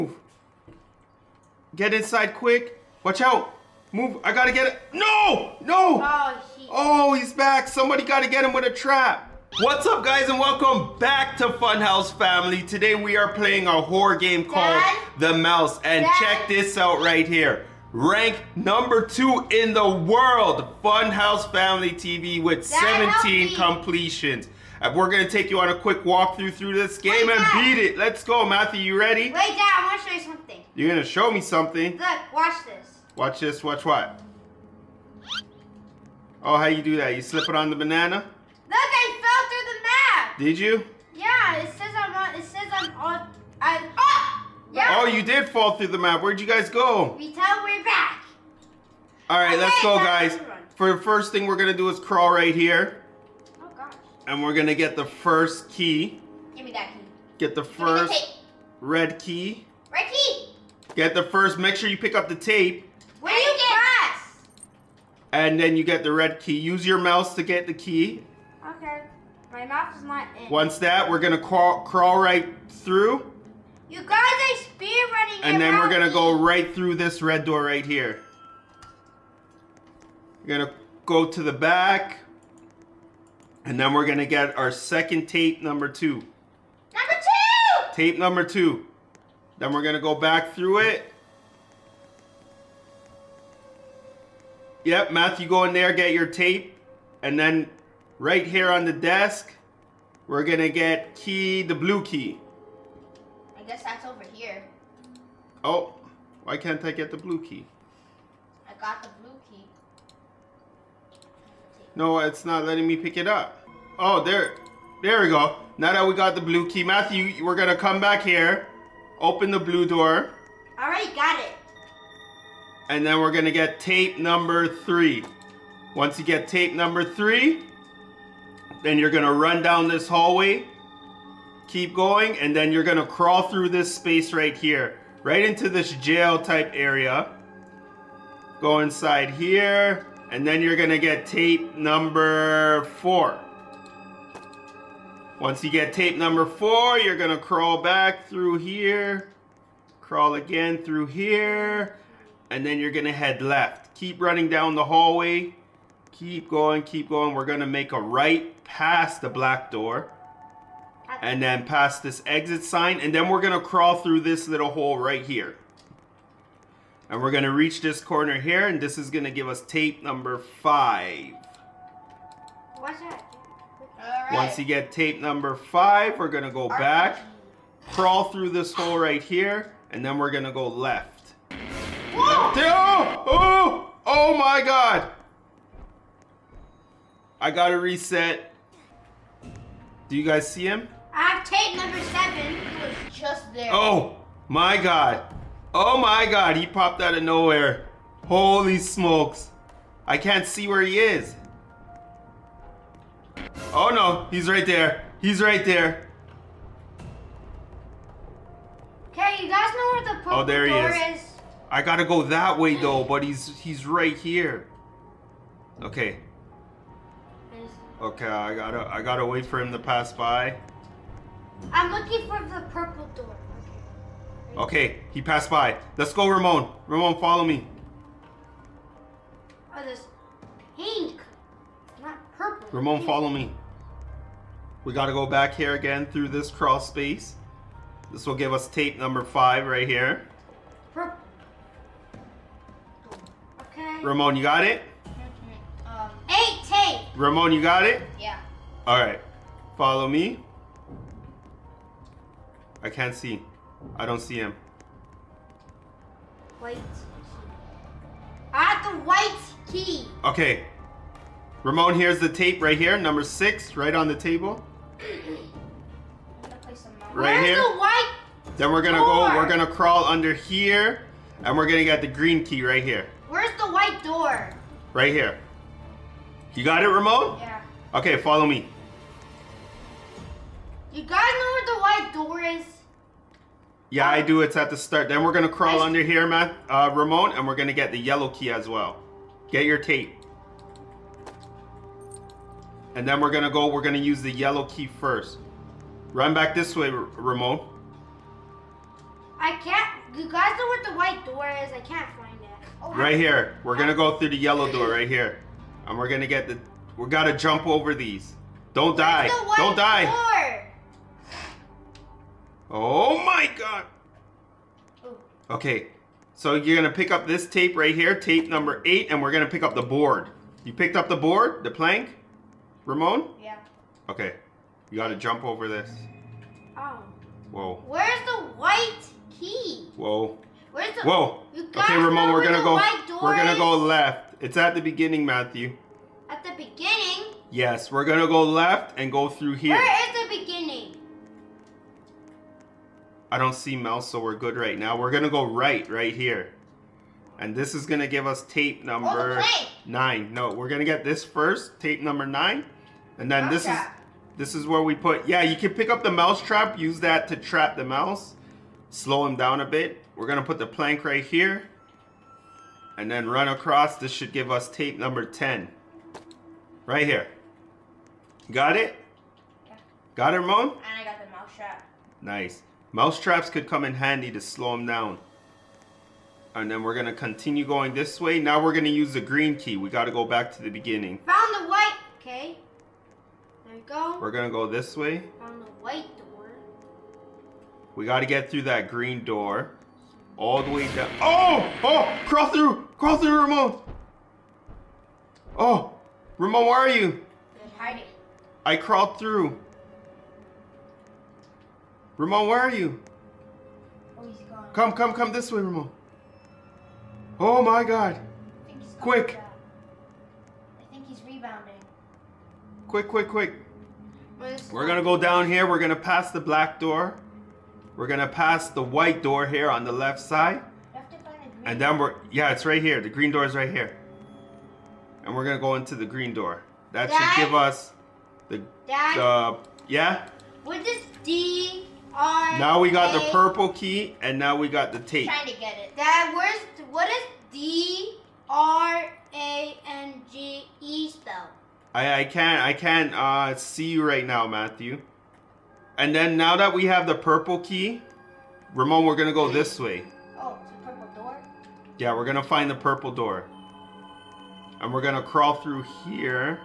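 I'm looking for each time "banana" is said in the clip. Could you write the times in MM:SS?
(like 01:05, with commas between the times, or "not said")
00:37.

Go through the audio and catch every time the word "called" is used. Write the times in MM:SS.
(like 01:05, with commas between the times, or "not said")
00:14.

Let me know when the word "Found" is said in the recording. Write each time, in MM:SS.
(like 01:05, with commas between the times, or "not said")
06:21, 06:25.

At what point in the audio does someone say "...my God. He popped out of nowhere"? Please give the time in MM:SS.
03:15.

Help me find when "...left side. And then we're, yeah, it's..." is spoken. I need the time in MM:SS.
06:59.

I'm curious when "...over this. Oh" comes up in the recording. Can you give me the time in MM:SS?
05:25.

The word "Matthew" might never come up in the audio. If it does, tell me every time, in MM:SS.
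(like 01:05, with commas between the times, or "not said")
00:28, 01:35, 01:56, 05:35, 07:24.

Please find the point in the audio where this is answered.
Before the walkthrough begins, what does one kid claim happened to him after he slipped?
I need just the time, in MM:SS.
00:39.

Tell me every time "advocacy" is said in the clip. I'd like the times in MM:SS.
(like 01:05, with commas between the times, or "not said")
not said.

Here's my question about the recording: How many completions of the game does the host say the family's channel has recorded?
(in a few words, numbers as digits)
17.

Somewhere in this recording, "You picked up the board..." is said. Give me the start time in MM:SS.
05:20.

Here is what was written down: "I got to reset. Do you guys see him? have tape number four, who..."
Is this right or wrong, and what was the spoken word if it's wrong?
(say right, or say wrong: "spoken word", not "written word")
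wrong: "seven", not "four".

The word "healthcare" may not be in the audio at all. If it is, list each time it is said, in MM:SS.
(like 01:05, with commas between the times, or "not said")
not said.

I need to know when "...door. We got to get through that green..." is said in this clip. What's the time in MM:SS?
06:26.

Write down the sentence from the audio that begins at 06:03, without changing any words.
This should give us tape number 10.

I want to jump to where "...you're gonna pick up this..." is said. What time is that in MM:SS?
05:16.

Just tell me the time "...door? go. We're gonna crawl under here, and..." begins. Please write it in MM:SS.
04:28.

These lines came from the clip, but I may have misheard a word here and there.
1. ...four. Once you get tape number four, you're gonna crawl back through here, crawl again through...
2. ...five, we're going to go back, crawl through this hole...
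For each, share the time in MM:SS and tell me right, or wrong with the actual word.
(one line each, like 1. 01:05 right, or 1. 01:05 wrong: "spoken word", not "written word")
1. 02:23 right
2. 02:55 right.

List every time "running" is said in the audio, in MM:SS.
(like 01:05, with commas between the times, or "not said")
01:15, 02:34.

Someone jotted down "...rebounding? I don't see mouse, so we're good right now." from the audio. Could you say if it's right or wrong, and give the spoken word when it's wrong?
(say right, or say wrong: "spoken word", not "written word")
wrong: "beginning", not "rebounding".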